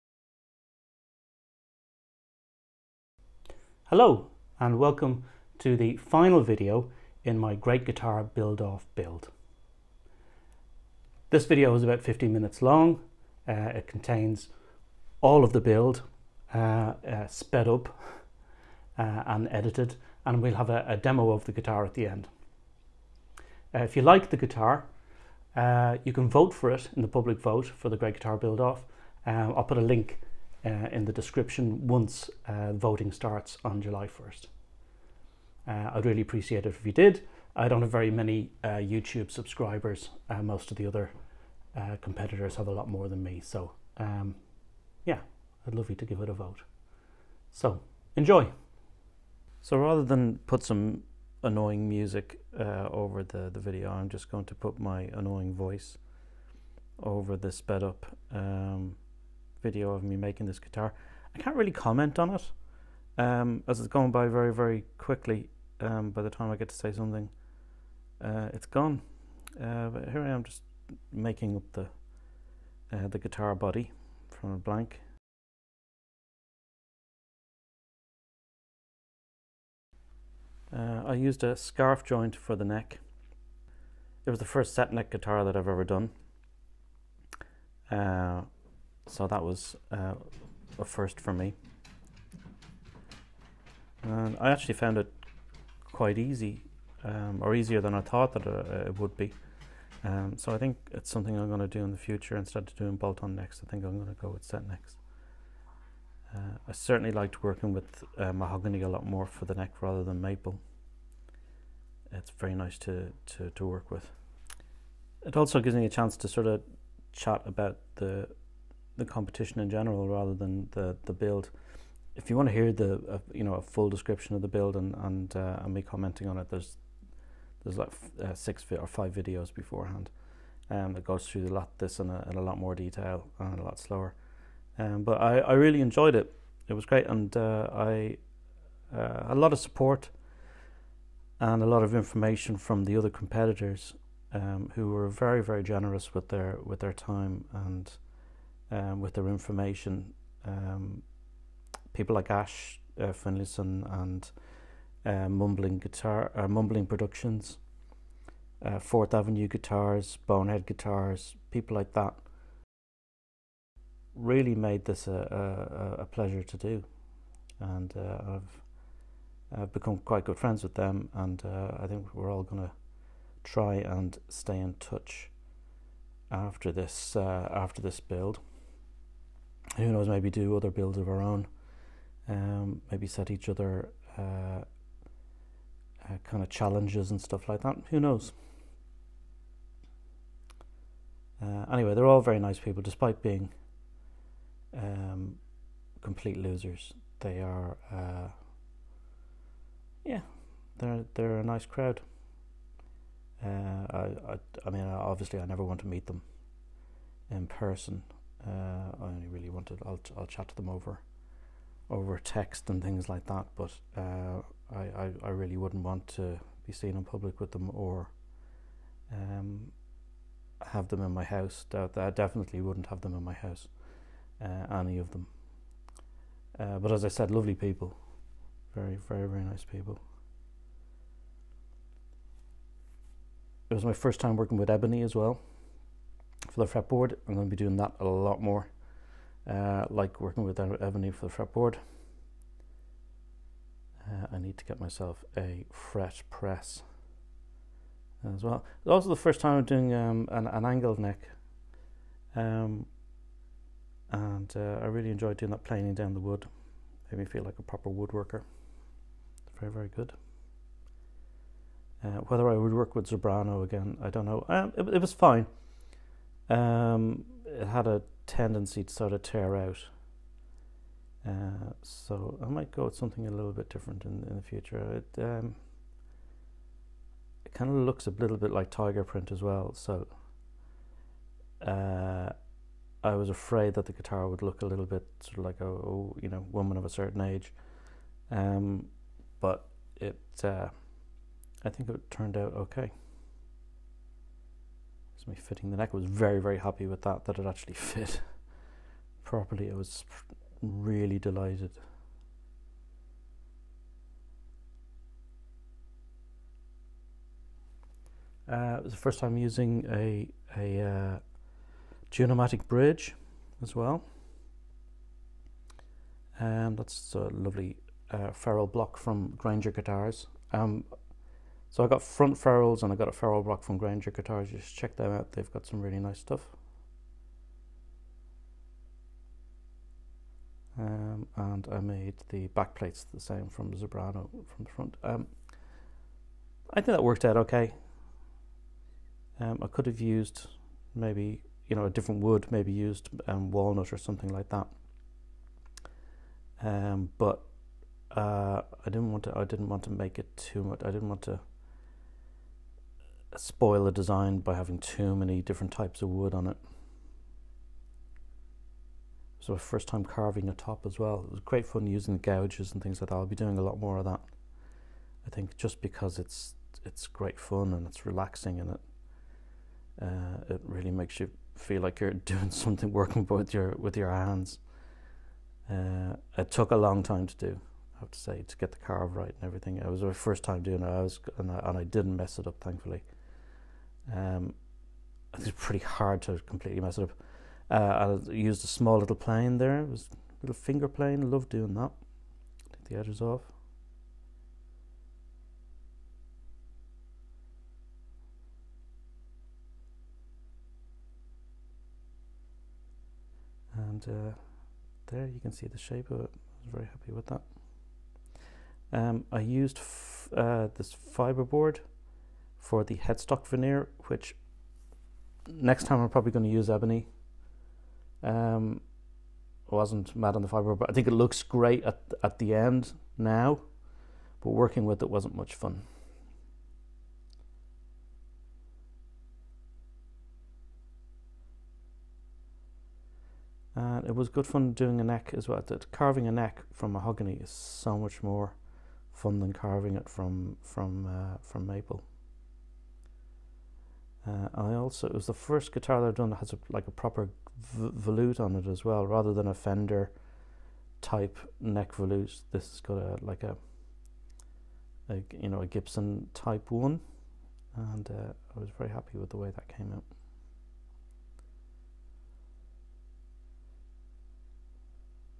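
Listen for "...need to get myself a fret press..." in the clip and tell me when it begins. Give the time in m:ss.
4:04.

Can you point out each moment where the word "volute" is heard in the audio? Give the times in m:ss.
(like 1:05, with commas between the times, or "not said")
7:27, 7:31.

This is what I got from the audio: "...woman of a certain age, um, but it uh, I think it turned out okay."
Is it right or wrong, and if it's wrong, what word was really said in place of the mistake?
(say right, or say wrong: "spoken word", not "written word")
right.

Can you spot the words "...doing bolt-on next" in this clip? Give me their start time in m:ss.
1:42.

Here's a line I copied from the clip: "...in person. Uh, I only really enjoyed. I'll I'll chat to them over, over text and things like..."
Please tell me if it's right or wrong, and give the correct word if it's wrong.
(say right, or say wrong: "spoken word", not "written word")
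wrong: "wanted", not "enjoyed".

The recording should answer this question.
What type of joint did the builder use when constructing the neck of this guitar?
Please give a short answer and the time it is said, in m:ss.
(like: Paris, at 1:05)
Scarf joint, at 1:21.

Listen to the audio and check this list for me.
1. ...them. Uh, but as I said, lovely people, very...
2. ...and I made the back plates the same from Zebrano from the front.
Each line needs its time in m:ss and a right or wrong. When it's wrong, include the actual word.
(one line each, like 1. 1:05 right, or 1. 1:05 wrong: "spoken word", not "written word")
1. 3:45 right
2. 5:31 right.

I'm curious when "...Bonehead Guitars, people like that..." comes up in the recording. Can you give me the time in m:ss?
2:40.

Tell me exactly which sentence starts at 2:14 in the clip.
Um, but I, I really enjoyed it.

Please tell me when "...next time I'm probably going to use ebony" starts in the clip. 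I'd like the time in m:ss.
6:55.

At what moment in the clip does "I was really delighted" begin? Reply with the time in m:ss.
4:59.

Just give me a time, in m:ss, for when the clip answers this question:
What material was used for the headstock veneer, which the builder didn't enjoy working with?
6:50.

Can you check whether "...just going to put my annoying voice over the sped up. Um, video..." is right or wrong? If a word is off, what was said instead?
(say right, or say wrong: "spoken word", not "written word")
right.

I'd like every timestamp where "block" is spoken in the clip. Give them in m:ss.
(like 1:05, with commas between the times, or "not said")
5:18, 5:23.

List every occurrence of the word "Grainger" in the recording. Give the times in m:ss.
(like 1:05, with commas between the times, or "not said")
5:19, 5:23.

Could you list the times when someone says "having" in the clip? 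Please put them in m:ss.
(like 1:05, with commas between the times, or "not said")
5:54.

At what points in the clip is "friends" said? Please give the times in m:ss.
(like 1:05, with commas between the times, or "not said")
2:50.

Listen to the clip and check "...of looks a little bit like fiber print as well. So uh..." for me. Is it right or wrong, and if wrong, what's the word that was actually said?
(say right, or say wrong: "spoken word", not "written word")
wrong: "tiger", not "fiber".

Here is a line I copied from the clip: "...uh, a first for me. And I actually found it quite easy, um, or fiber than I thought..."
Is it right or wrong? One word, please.
wrong.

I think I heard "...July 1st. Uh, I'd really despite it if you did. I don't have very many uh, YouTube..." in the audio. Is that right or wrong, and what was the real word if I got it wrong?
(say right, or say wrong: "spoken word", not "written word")
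wrong: "appreciate", not "despite".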